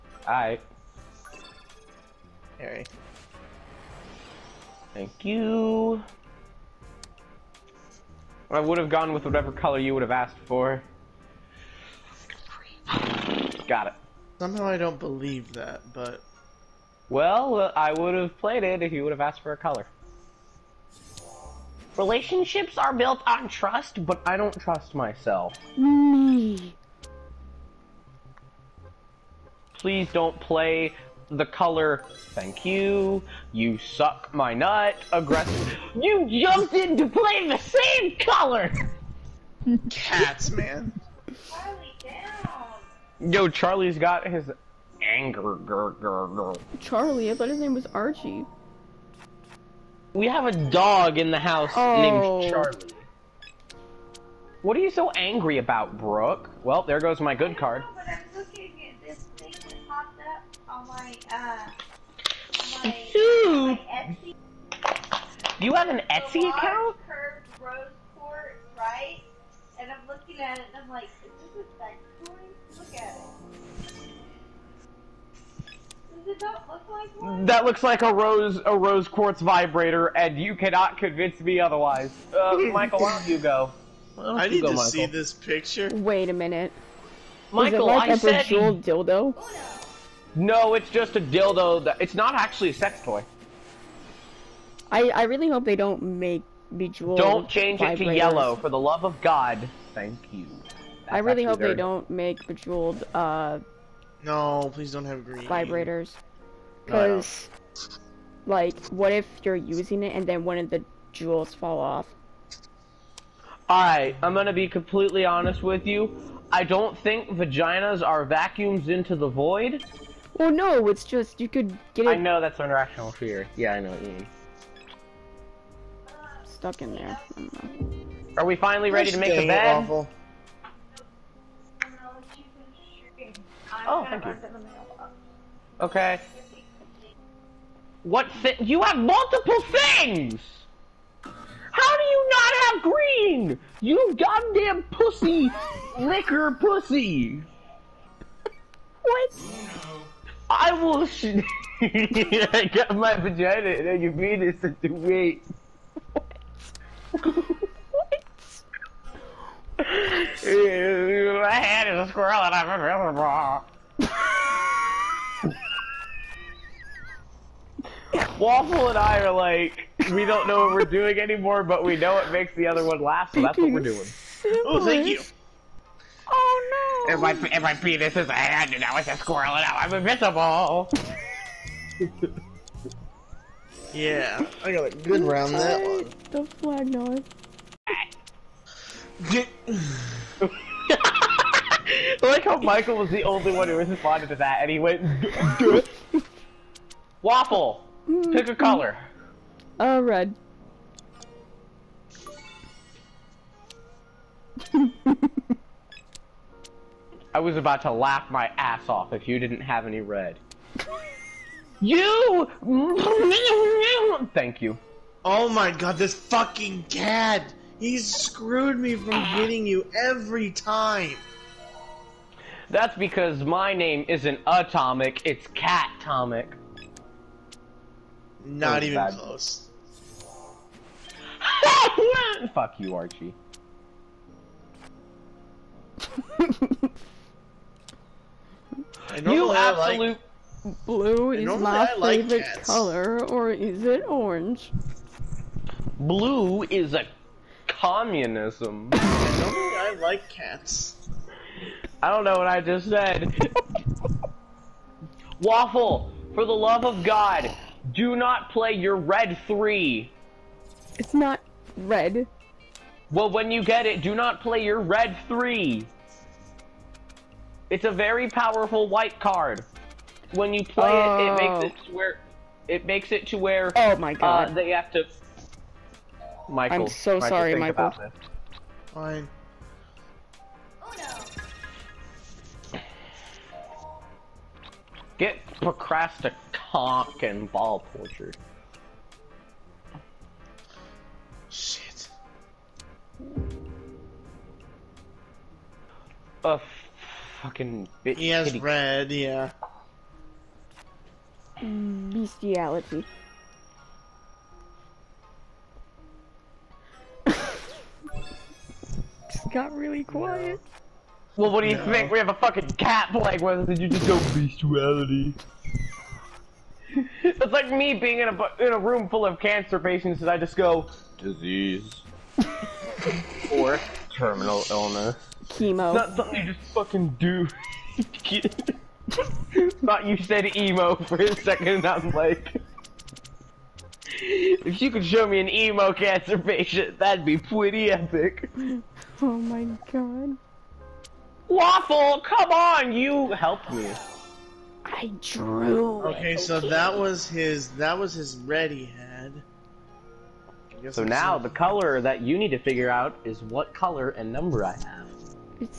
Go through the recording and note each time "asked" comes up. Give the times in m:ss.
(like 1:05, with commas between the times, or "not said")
0:10, 0:19.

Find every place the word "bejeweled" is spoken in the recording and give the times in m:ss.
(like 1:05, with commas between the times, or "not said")
1:28, 1:36, 1:42.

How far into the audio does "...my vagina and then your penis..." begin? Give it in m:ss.
2:32.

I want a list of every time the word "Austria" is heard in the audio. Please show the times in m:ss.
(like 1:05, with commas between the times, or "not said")
not said.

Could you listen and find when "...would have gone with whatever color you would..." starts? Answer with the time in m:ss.
0:08.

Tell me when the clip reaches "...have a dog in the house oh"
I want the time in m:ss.
0:50.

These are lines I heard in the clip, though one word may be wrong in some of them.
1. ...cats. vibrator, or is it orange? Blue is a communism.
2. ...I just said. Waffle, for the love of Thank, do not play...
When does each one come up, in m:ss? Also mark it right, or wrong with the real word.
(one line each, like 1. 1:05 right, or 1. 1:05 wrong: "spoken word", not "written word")
1. 4:02 wrong: "color", not "vibrator"
2. 4:12 wrong: "God", not "Thank".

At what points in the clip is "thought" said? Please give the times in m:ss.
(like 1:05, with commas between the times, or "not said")
0:47, 5:29.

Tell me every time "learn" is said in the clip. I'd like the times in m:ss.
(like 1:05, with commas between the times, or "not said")
not said.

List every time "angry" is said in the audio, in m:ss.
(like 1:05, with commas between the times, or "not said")
0:55.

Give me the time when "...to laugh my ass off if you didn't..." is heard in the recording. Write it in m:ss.
3:27.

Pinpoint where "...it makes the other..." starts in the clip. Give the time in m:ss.
2:52.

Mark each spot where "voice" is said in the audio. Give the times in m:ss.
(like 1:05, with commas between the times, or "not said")
not said.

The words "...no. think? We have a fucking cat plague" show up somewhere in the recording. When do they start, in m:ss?
5:11.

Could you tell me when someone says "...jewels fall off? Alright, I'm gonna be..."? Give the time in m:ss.
1:51.